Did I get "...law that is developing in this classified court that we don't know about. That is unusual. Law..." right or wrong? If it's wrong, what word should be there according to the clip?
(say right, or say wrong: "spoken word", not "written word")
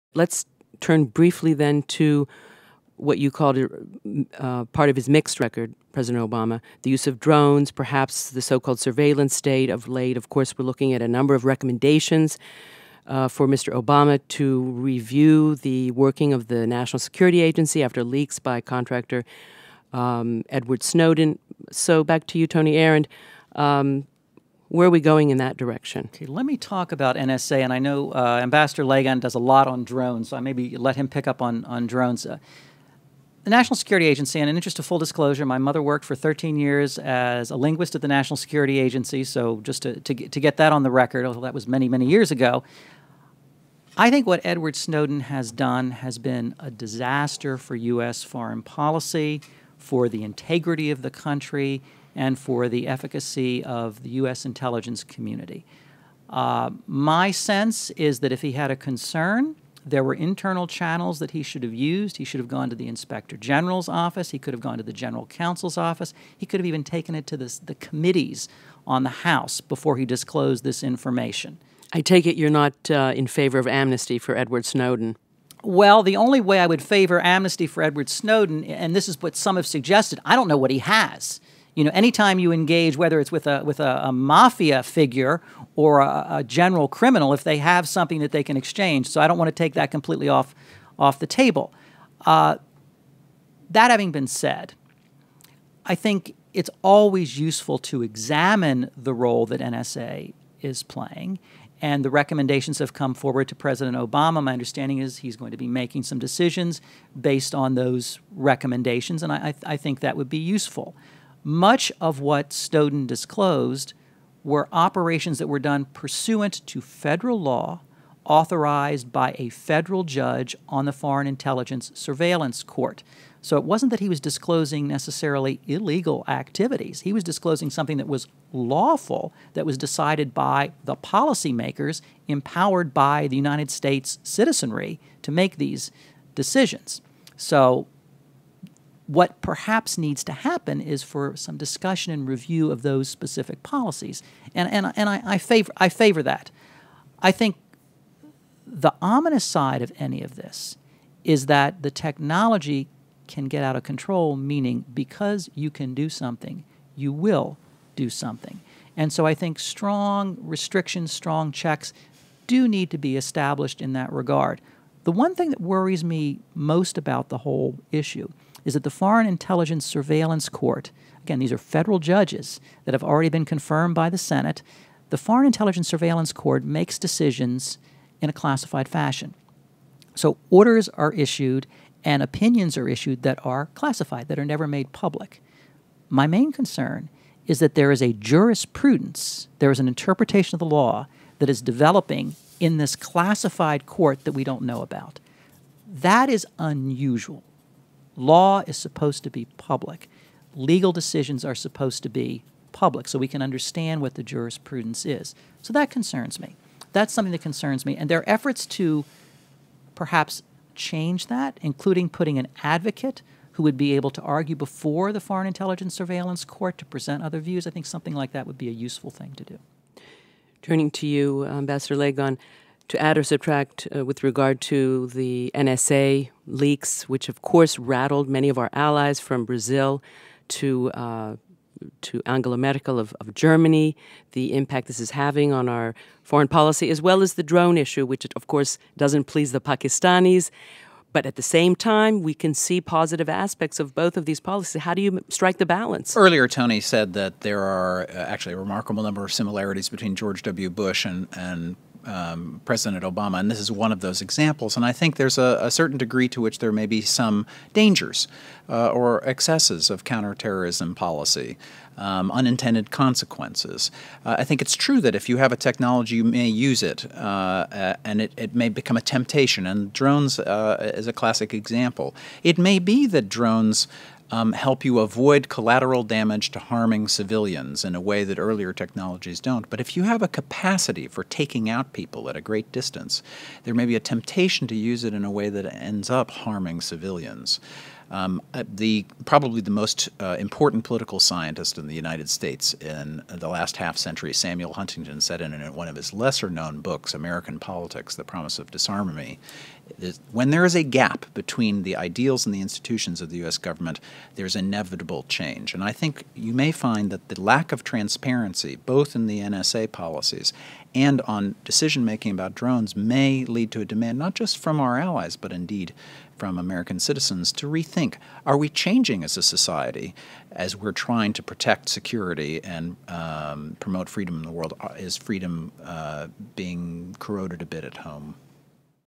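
right.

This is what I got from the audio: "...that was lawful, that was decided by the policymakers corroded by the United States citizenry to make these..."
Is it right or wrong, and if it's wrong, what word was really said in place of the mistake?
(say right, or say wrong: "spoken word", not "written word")
wrong: "empowered", not "corroded".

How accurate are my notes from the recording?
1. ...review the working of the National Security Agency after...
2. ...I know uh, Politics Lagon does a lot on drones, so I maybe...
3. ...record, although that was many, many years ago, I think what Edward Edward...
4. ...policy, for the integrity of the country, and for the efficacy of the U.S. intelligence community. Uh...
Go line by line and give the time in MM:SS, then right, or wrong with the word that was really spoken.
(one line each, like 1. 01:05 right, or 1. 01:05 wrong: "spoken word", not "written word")
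1. 00:14 right
2. 00:27 wrong: "Ambassador", not "Politics"
3. 00:40 wrong: "Snowden", not "Edward"
4. 00:48 right.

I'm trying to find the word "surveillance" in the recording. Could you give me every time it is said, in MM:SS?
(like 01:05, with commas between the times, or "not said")
00:08, 02:01, 02:49, 02:55, 03:35.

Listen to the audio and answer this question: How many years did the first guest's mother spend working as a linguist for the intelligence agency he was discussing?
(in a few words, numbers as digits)
13.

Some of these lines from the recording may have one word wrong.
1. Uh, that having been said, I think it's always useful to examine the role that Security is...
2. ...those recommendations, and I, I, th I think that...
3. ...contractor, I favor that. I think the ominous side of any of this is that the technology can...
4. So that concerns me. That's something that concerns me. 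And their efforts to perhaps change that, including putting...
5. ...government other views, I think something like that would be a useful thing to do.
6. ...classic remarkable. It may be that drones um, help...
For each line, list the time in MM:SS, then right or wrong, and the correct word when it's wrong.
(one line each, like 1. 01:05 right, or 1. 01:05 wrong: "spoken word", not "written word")
1. 01:32 wrong: "NSA", not "Security"
2. 01:47 right
3. 02:25 wrong: "favor", not "contractor"
4. 03:25 right
5. 03:36 wrong: "present", not "government"
6. 04:31 wrong: "example", not "remarkable".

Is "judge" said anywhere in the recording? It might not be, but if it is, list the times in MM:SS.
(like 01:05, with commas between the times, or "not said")
02:00, 02:51.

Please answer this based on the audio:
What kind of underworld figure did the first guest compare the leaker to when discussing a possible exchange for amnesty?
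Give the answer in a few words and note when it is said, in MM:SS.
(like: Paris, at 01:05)
Mafia figure, at 01:24.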